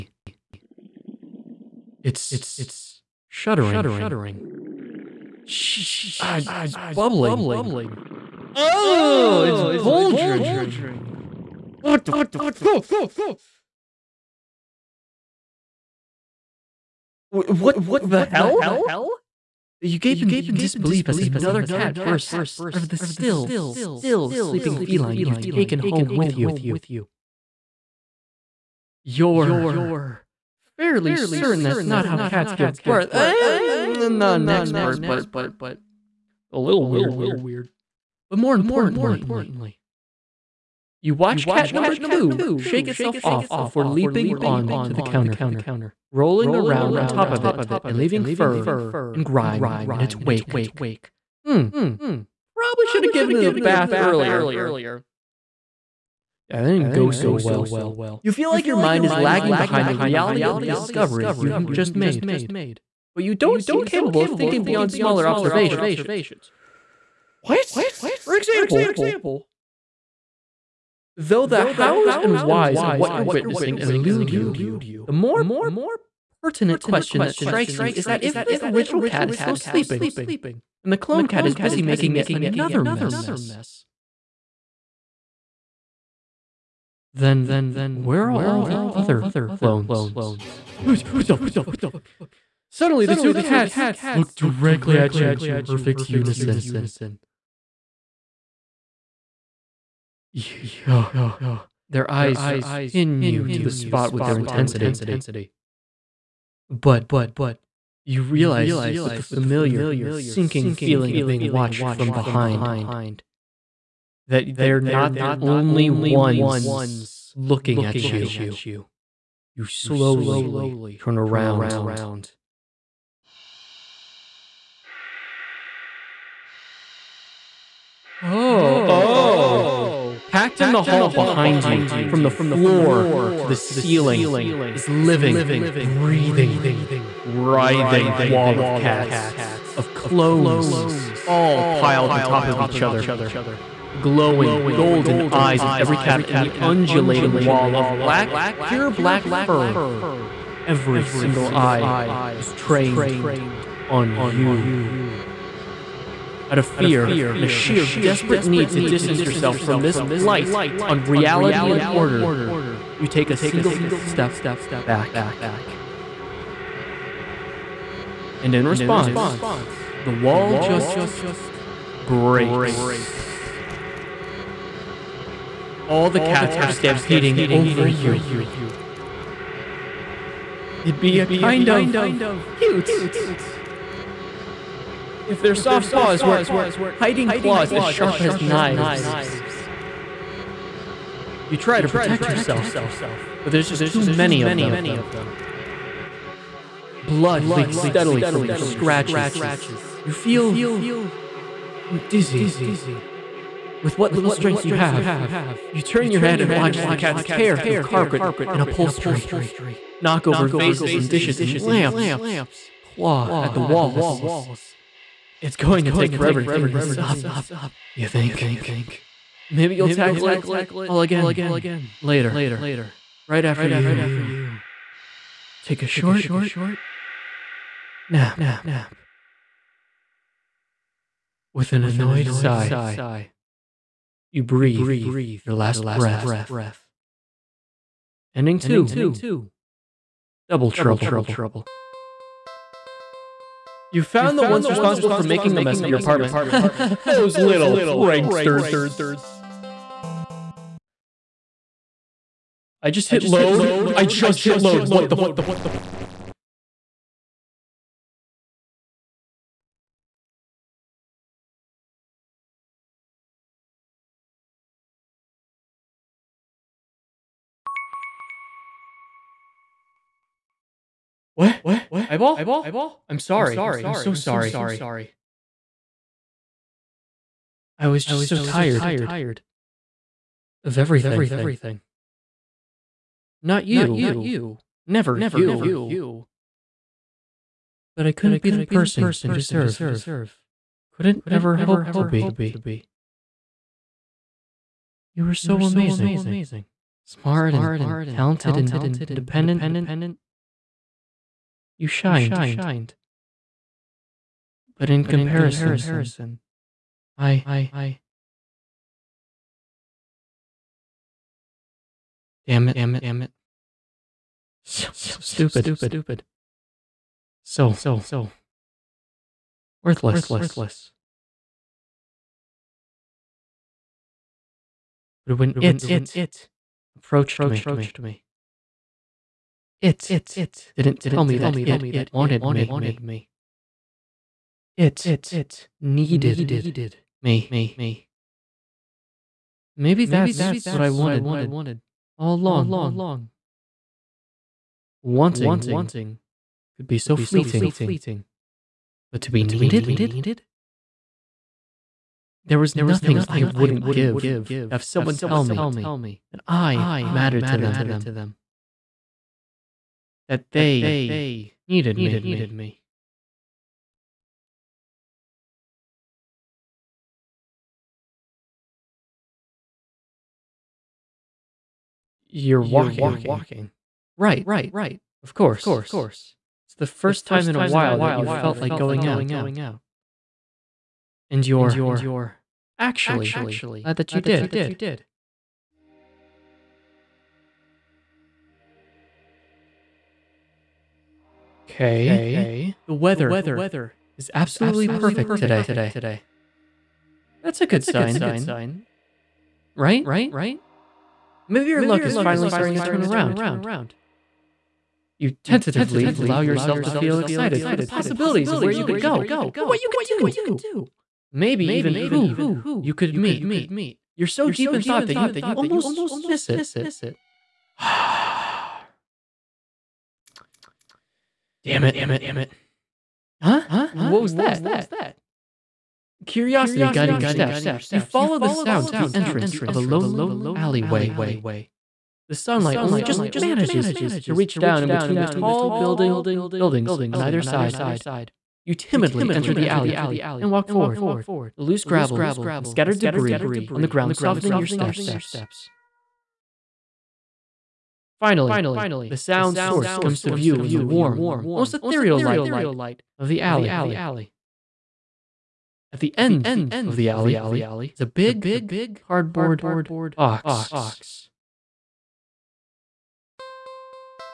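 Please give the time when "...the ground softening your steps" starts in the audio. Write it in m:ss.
7:23.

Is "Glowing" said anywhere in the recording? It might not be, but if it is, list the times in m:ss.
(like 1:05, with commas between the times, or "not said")
2:24.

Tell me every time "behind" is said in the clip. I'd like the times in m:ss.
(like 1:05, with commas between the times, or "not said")
0:59, 1:52, 2:11.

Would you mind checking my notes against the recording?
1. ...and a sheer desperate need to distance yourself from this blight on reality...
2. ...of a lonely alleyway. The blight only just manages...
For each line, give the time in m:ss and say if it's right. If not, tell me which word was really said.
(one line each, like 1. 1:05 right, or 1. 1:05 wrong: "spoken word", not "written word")
1. 2:37 right
2. 7:09 wrong: "sunlight", not "blight".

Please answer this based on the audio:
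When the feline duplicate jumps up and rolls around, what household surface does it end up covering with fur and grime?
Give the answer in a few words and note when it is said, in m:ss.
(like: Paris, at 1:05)
The counter, at 0:45.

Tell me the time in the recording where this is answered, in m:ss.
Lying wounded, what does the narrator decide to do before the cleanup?
3:45.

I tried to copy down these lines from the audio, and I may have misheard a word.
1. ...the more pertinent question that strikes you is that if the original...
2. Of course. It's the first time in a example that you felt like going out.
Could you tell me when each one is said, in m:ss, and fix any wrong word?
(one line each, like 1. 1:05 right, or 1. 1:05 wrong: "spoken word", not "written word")
1. 1:15 right
2. 6:15 wrong: "while", not "example".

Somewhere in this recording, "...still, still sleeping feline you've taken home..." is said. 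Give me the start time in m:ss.
0:22.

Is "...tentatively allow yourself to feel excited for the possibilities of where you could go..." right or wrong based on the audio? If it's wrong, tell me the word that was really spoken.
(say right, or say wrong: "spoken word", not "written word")
right.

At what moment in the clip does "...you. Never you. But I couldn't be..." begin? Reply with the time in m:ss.
4:43.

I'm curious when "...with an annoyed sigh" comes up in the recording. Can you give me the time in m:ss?
3:51.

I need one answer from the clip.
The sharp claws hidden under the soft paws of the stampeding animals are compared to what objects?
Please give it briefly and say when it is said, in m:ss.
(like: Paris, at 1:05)
Knives, at 3:08.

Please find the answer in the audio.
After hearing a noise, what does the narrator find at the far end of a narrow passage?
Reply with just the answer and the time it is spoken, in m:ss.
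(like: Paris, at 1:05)
A big cardboard box, at 7:38.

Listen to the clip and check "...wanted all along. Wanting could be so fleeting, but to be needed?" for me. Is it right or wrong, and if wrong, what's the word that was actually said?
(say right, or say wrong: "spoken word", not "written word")
right.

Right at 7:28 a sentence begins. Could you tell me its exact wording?
Finally, the sound source comes to view in the warm, almost ethereal light of the alley.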